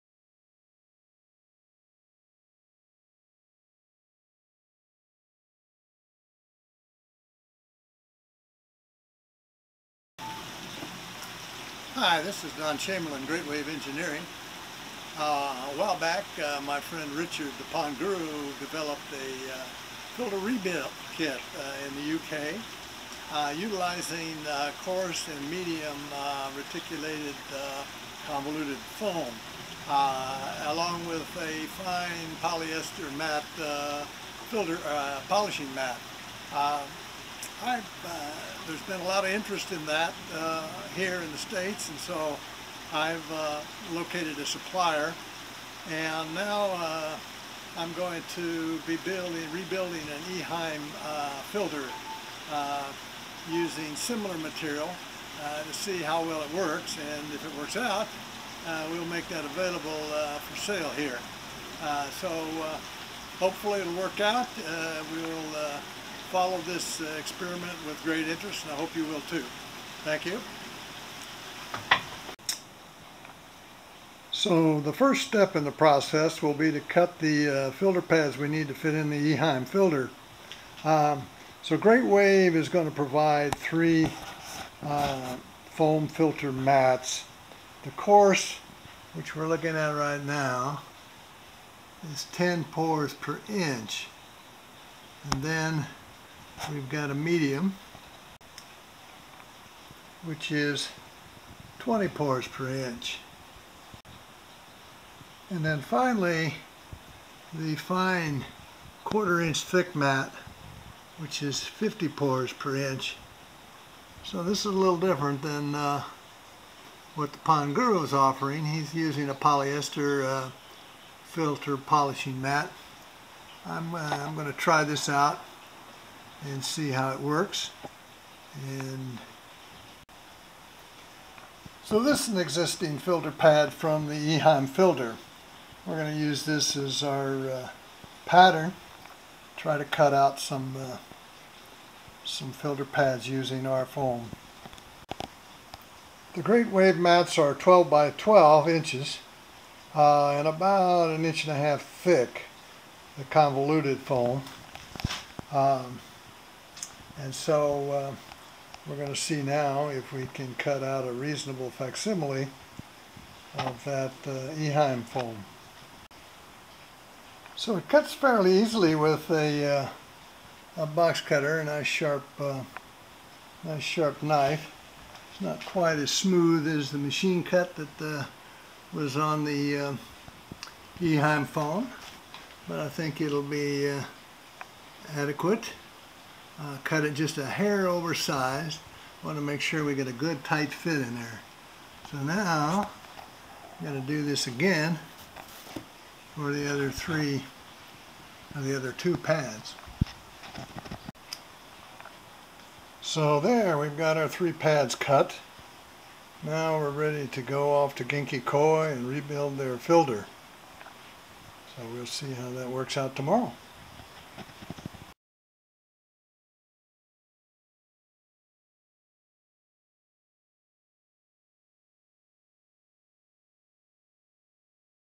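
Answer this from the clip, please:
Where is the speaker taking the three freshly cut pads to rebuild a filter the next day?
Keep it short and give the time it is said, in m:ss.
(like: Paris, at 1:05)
Genki Koi, at 3:28.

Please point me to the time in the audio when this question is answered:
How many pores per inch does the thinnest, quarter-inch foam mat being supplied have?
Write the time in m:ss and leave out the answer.
1:51.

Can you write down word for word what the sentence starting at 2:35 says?
Um, and so uh, we're going to see now if we can cut out a reasonable facsimile of that uh, Eheim foam.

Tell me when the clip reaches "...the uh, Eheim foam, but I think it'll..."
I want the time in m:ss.
2:59.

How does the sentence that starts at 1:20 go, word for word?
Um, so Great Wave is going to provide three uh, foam filter mats.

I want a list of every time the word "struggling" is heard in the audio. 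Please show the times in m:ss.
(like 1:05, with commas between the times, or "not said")
not said.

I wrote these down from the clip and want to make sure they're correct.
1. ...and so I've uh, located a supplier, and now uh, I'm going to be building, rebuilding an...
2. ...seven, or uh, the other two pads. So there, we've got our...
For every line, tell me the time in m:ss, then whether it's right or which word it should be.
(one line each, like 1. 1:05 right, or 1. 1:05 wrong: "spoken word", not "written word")
1. 0:41 right
2. 3:16 wrong: "three", not "seven".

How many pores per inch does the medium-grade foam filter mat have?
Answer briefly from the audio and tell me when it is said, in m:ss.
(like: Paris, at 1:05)
20, at 1:41.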